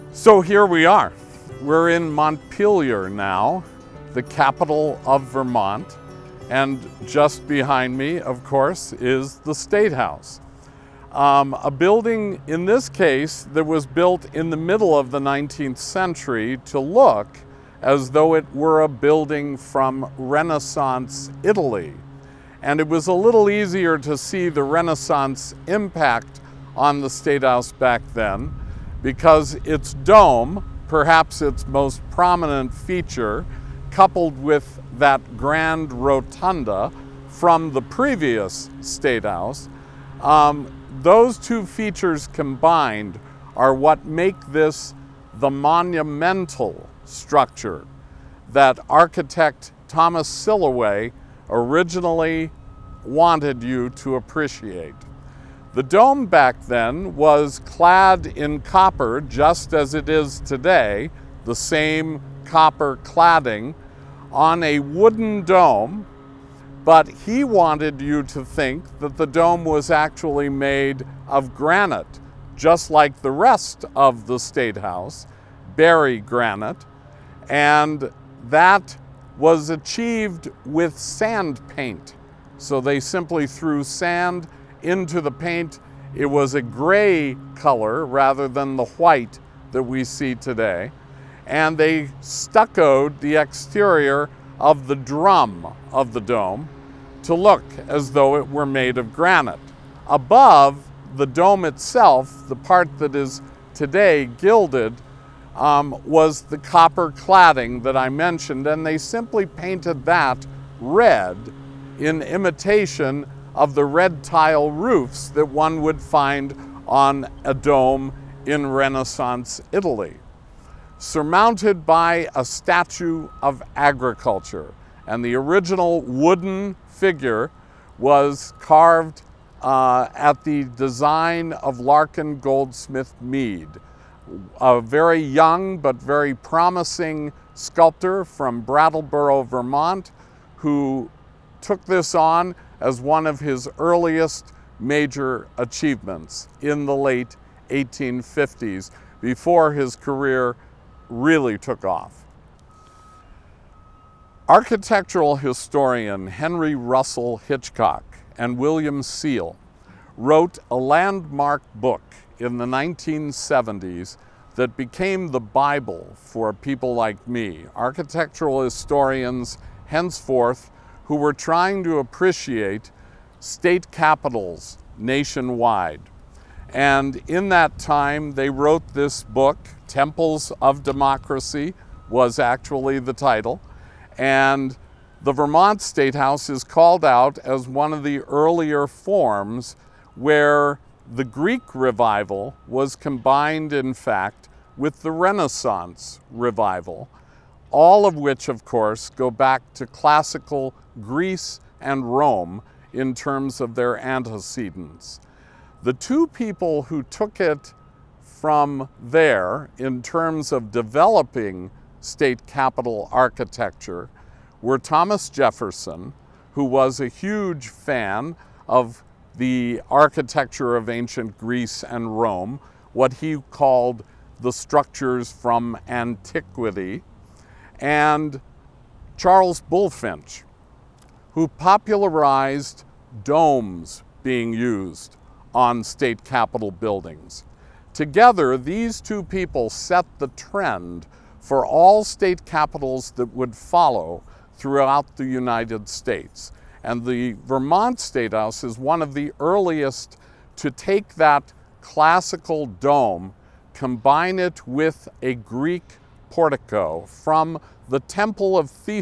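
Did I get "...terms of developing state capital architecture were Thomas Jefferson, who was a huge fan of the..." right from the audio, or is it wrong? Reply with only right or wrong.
right.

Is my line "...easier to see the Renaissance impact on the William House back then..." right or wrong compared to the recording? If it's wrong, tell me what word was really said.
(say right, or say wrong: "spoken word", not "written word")
wrong: "State", not "William".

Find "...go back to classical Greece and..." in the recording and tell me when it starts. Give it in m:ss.
3:19.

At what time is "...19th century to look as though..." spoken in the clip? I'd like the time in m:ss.
0:15.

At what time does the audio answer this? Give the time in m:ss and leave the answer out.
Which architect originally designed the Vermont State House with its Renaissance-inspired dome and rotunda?
0:49.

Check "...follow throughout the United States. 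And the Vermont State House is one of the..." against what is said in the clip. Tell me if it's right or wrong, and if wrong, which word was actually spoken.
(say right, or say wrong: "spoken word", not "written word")
right.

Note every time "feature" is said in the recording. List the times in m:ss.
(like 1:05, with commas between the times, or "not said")
0:32, 0:41.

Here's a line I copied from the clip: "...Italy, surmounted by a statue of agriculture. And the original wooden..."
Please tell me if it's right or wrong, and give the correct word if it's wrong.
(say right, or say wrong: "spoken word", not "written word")
right.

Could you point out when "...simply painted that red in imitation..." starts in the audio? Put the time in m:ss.
1:48.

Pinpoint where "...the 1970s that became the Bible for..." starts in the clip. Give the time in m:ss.
2:42.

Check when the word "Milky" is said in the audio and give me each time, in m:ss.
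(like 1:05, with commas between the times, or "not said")
not said.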